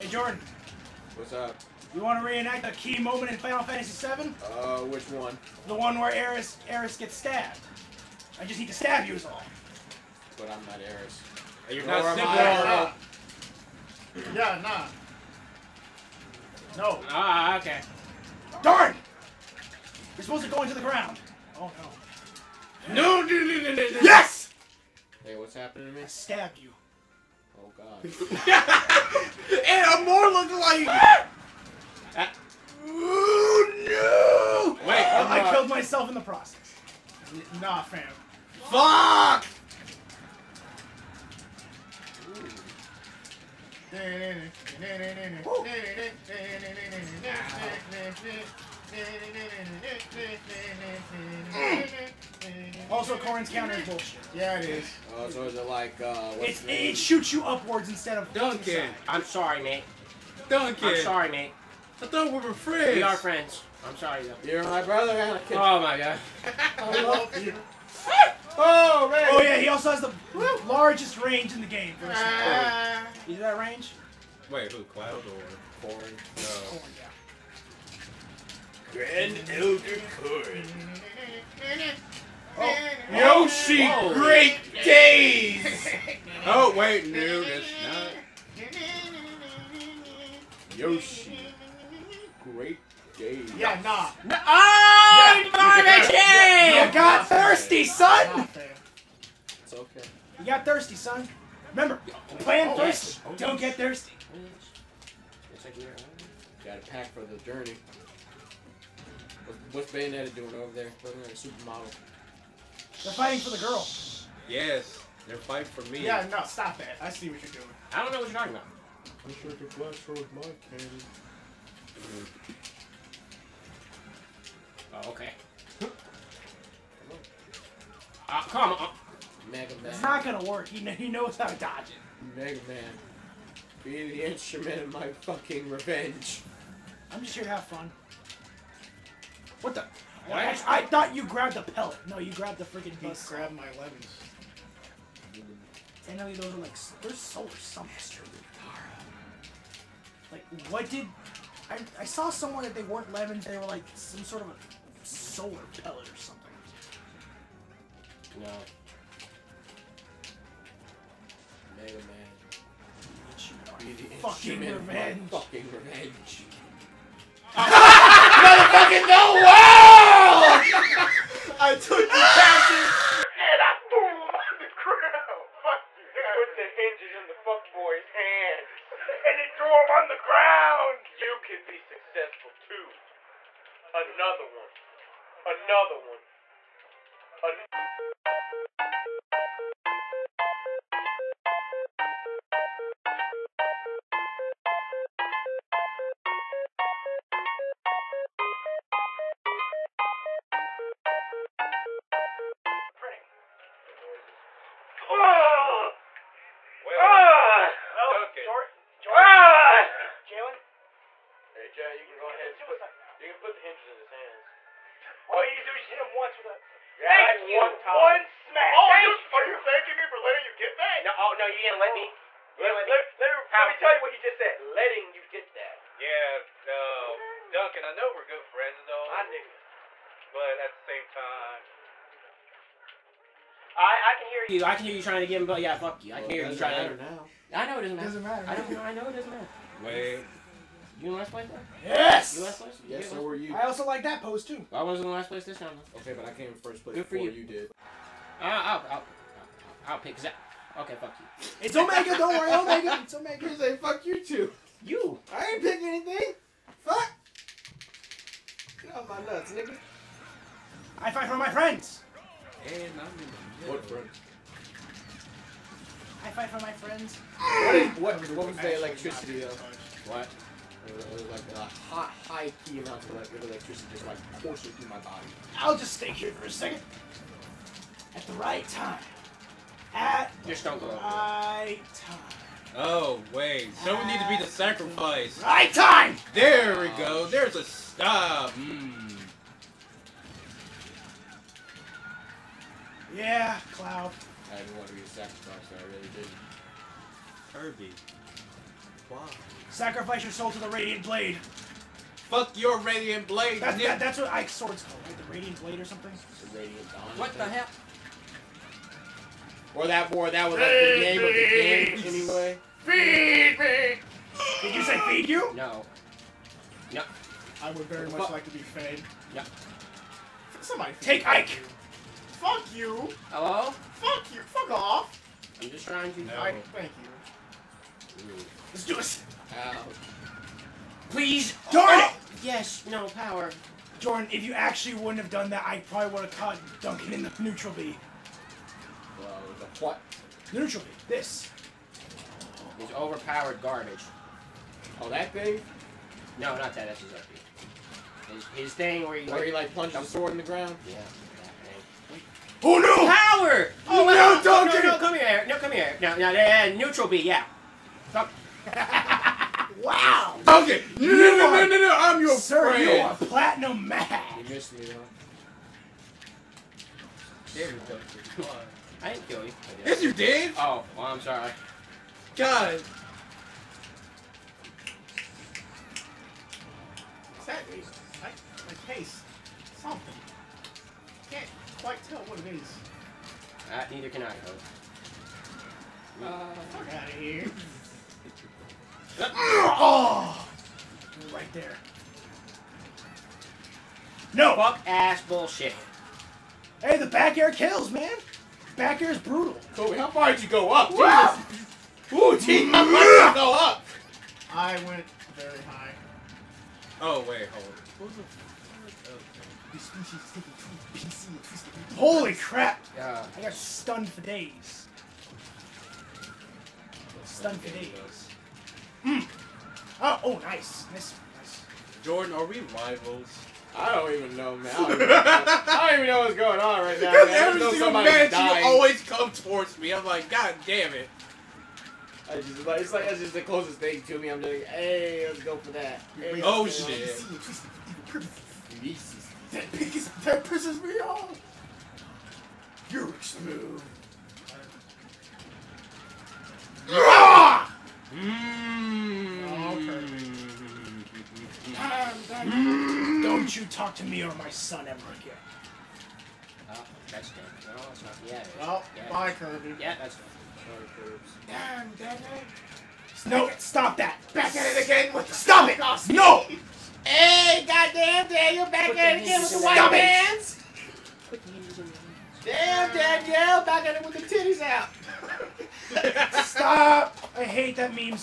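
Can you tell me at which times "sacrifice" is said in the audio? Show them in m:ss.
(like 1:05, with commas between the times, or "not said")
4:44, 4:55, 4:59.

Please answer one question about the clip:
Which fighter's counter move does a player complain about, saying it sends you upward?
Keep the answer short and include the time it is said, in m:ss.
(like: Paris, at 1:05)
Corrin, at 0:53.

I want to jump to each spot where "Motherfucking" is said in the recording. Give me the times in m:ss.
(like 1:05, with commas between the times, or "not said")
2:47.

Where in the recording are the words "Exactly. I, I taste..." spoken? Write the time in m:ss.
6:17.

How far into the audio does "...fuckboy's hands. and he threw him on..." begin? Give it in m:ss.
2:57.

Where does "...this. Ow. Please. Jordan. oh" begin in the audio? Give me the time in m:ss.
5:28.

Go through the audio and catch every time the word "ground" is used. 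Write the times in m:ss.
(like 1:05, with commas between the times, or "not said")
0:20, 3:00, 5:50.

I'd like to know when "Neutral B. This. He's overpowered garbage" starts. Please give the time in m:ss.
5:40.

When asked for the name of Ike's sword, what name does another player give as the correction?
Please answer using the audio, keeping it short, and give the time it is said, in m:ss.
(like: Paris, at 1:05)
The Radiant Dawn, at 5:06.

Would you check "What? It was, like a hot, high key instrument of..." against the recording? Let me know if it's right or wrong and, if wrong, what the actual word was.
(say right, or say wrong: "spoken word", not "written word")
wrong: "amount", not "instrument".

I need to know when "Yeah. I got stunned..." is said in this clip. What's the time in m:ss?
6:52.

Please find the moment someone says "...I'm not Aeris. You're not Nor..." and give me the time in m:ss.
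0:10.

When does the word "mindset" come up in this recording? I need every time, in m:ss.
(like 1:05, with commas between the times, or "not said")
not said.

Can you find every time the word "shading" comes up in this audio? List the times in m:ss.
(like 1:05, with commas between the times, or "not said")
not said.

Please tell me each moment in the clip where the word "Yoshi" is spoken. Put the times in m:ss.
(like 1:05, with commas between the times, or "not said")
1:23, 1:30.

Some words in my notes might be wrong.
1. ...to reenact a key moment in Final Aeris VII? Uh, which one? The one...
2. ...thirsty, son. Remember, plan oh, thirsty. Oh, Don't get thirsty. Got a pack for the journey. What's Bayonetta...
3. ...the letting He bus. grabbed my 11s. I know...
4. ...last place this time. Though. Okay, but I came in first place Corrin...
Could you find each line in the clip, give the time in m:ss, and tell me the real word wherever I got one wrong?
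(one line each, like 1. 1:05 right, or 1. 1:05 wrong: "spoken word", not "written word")
1. 0:02 wrong: "Fantasy", not "Aeris"
2. 1:40 right
3. 2:22 wrong: "freaking", not "letting"
4. 4:05 wrong: "Good", not "Corrin".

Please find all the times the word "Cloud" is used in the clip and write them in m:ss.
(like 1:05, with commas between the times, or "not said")
1:14, 4:53.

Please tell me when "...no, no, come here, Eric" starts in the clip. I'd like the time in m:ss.
5:54.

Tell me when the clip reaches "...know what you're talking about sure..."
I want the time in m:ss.
1:58.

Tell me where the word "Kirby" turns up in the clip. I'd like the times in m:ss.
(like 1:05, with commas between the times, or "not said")
4:57, 7:39.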